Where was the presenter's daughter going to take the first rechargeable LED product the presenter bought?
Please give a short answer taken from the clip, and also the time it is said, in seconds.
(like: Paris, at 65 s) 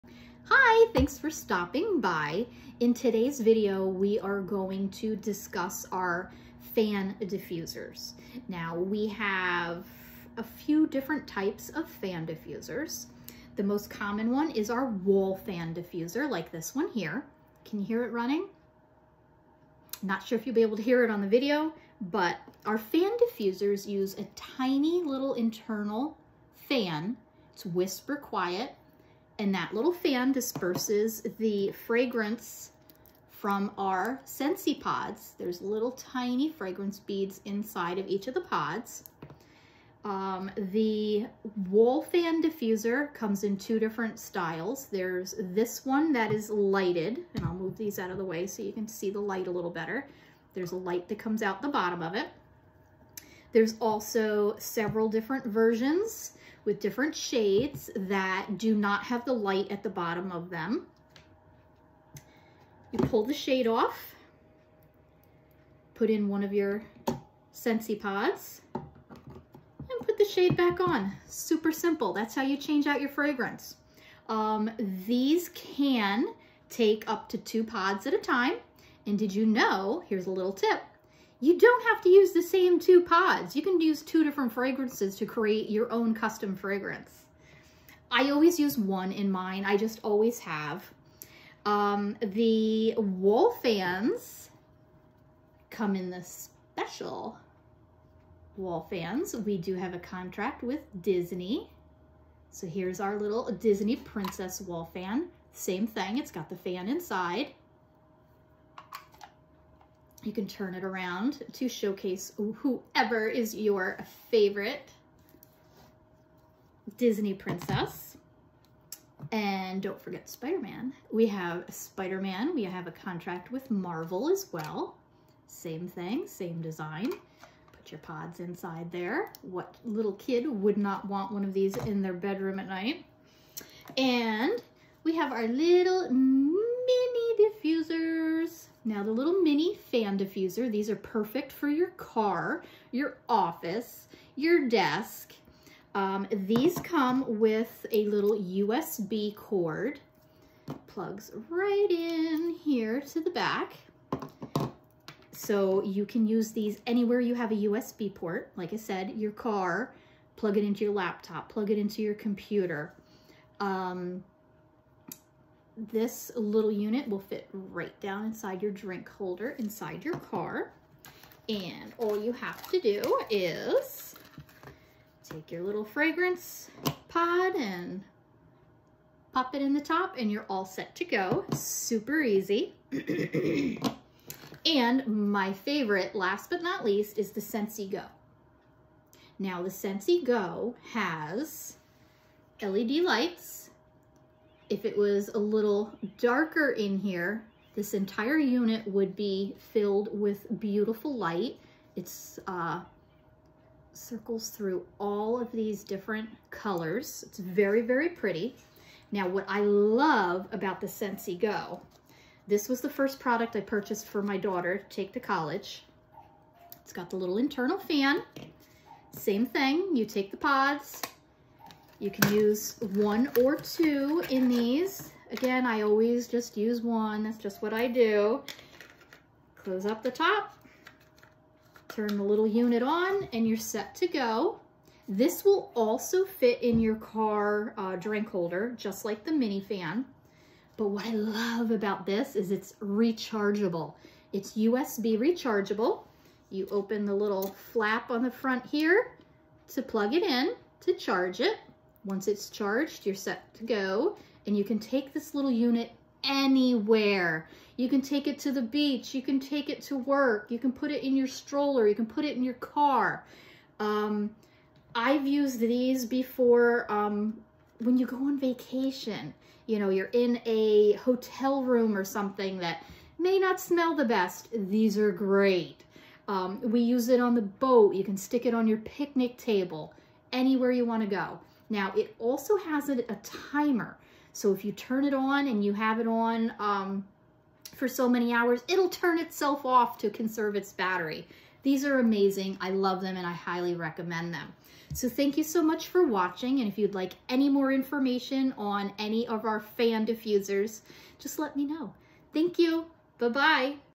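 college, at 215 s.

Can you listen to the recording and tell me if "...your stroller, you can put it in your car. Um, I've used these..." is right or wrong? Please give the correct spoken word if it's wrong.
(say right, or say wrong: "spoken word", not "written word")
right.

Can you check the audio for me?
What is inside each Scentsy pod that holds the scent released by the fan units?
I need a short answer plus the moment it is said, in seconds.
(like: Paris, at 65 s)
fragrance beads, at 36 s.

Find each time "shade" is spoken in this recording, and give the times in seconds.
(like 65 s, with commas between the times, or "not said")
57 s, 63 s, 70 s.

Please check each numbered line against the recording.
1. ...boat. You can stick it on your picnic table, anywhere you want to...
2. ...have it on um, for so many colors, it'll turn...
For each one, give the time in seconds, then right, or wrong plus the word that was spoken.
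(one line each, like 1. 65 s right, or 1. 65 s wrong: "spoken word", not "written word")
1. 277 s right
2. 285 s wrong: "hours", not "colors".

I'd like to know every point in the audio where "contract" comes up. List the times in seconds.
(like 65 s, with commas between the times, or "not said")
99 s, 122 s.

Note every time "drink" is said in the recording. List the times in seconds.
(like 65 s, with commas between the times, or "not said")
168 s, 237 s.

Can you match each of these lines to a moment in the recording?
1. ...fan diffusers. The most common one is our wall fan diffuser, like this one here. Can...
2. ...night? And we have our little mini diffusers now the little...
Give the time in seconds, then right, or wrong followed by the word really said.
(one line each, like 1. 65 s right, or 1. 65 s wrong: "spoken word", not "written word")
1. 11 s right
2. 132 s right.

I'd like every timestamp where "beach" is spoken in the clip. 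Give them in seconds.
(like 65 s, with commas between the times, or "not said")
258 s.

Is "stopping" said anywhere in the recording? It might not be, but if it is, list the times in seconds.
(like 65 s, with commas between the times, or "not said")
1 s.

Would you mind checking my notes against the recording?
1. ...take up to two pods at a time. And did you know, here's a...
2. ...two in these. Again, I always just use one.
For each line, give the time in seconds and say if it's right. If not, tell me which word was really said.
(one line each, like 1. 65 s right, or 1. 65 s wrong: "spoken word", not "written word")
1. 76 s right
2. 223 s right.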